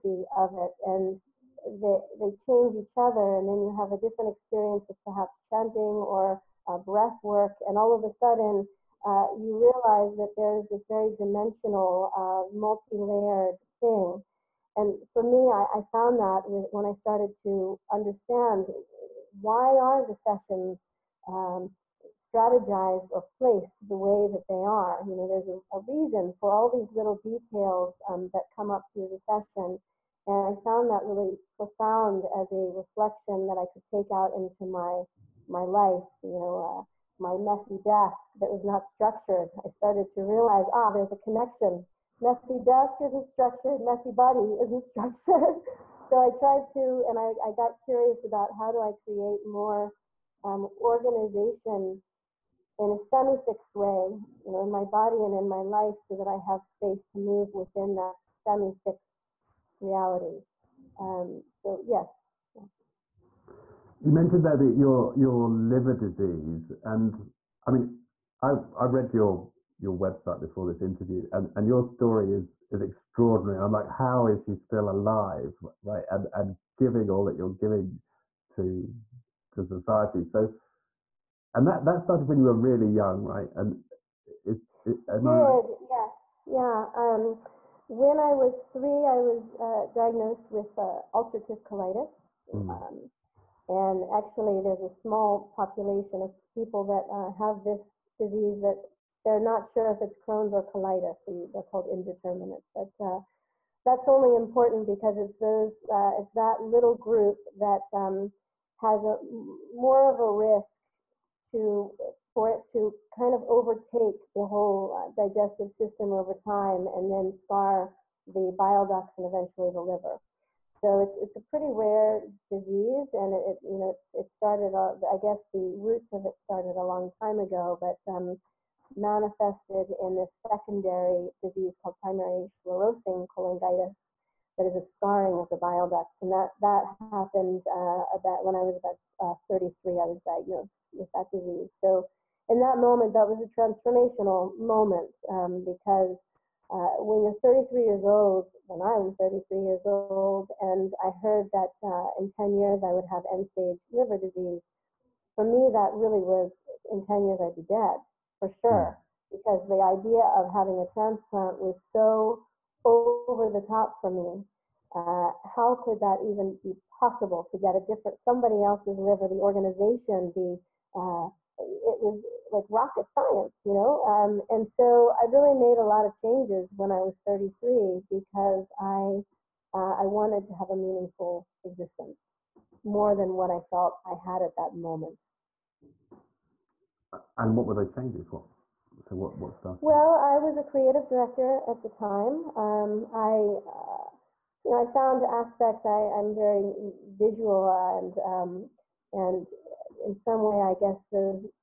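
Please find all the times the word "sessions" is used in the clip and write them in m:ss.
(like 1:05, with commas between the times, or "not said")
0:20, 0:29.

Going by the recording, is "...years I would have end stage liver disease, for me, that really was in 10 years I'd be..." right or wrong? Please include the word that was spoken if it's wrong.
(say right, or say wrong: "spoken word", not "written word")
right.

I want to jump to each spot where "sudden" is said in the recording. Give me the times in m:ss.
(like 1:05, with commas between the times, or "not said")
0:08.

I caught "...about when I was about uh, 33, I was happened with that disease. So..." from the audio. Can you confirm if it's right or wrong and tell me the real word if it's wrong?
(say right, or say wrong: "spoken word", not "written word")
wrong: "diagnosed", not "happened".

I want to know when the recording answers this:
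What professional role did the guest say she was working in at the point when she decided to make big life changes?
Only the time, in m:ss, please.
3:10.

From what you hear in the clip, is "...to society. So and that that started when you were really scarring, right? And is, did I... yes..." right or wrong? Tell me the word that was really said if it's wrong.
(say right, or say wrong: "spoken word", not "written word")
wrong: "young", not "scarring".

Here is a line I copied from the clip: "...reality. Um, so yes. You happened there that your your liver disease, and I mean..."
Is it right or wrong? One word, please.
wrong.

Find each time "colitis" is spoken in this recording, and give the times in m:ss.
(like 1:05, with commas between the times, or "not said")
1:31, 1:40.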